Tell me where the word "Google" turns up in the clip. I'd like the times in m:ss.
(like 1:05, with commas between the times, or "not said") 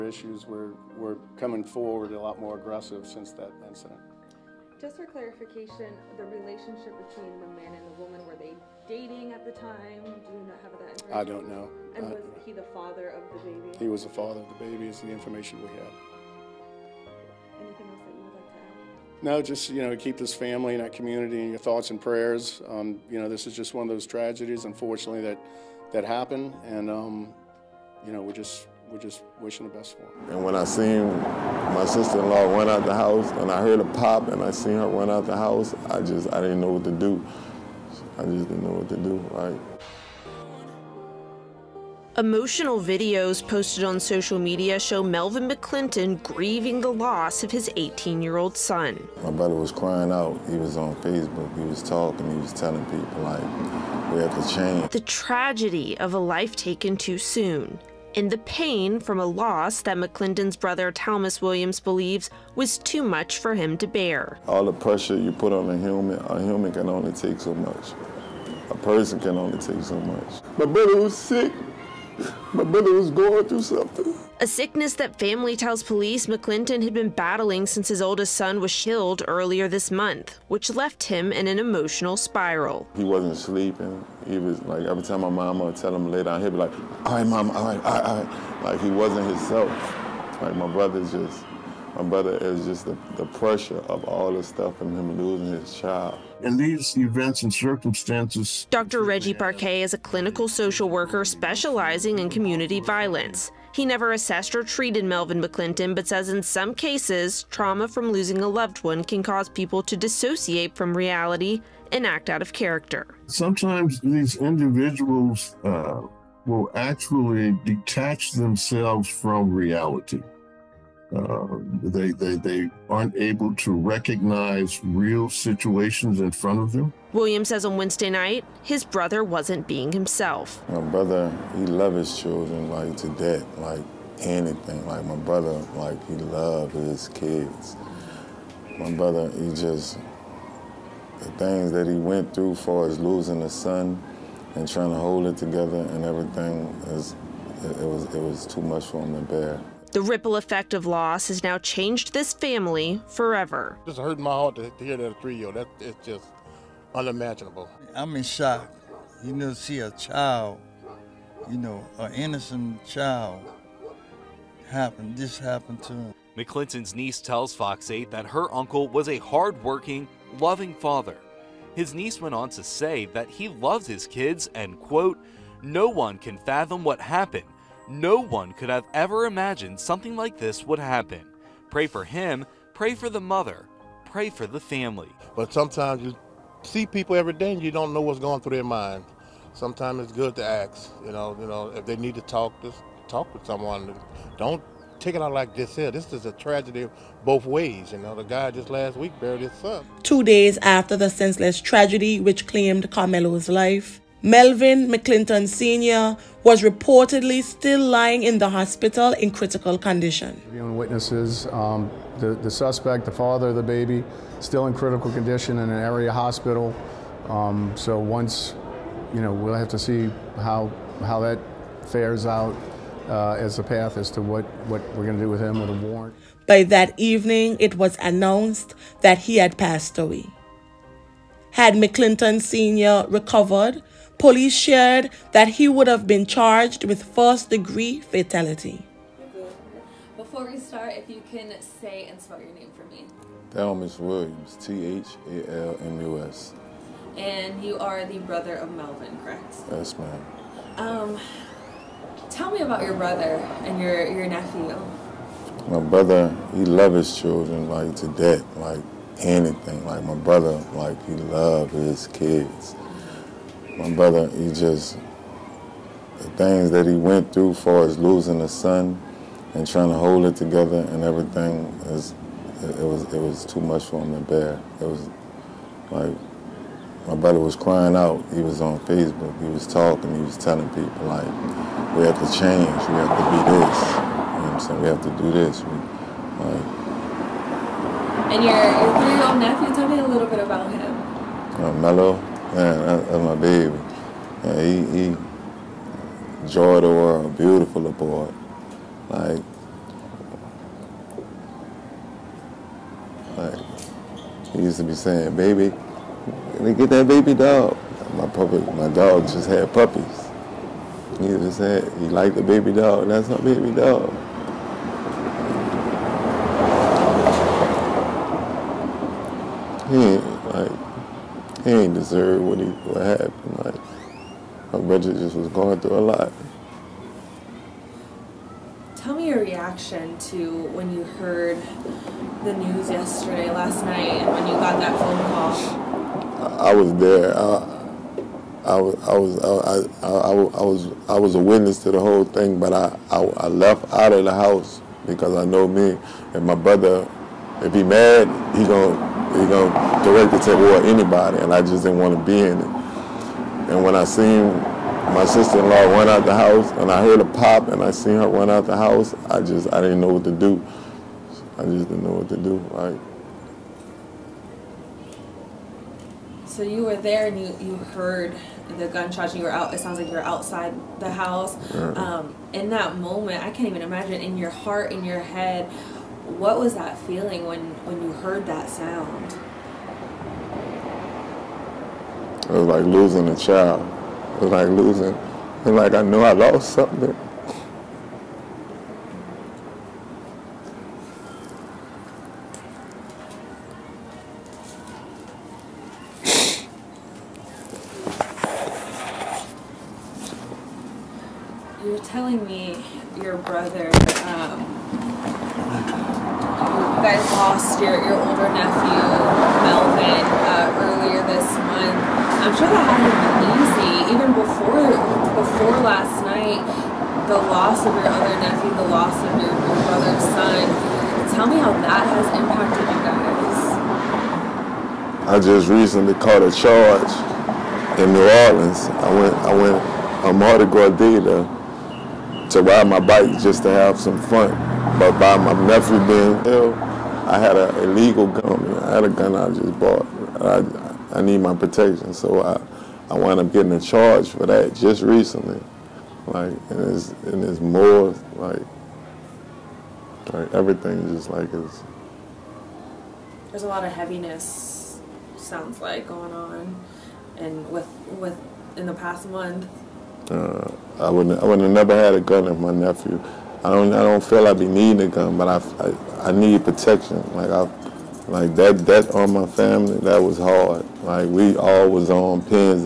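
not said.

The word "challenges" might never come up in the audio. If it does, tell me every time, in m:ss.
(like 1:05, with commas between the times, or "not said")
not said.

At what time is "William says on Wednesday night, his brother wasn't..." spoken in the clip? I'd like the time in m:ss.
2:07.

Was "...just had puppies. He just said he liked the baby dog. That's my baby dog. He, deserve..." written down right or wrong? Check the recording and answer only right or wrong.
right.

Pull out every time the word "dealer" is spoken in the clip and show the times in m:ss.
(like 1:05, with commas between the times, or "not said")
7:10.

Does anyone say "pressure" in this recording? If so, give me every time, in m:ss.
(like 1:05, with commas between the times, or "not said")
1:04, 1:33.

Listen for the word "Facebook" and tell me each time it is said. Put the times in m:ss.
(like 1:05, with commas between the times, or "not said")
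0:50, 4:38.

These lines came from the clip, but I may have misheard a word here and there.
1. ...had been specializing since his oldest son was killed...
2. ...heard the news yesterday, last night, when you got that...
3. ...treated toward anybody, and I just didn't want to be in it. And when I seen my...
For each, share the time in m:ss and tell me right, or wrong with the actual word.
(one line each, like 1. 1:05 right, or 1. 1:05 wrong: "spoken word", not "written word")
1. 1:16 wrong: "battling", not "specializing"
2. 5:31 right
3. 5:50 wrong: "directed", not "treated".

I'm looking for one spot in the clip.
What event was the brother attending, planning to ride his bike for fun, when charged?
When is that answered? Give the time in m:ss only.
7:10.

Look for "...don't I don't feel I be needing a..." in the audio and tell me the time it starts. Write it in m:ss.
7:43.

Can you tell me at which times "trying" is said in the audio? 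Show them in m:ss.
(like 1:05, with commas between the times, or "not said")
2:24, 4:29.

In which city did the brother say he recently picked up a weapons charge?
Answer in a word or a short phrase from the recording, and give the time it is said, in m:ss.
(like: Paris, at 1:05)
New Orleans, at 7:08.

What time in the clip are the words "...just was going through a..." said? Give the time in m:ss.
5:25.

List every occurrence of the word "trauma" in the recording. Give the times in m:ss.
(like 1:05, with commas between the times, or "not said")
1:47.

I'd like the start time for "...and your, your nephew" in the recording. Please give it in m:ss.
4:13.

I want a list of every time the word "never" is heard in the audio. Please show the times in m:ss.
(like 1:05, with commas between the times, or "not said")
1:43, 7:41.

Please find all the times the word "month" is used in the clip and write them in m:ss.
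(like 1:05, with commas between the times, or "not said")
1:19, 7:39.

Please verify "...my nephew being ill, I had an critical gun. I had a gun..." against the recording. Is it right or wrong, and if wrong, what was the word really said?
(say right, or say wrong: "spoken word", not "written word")
wrong: "illegal", not "critical".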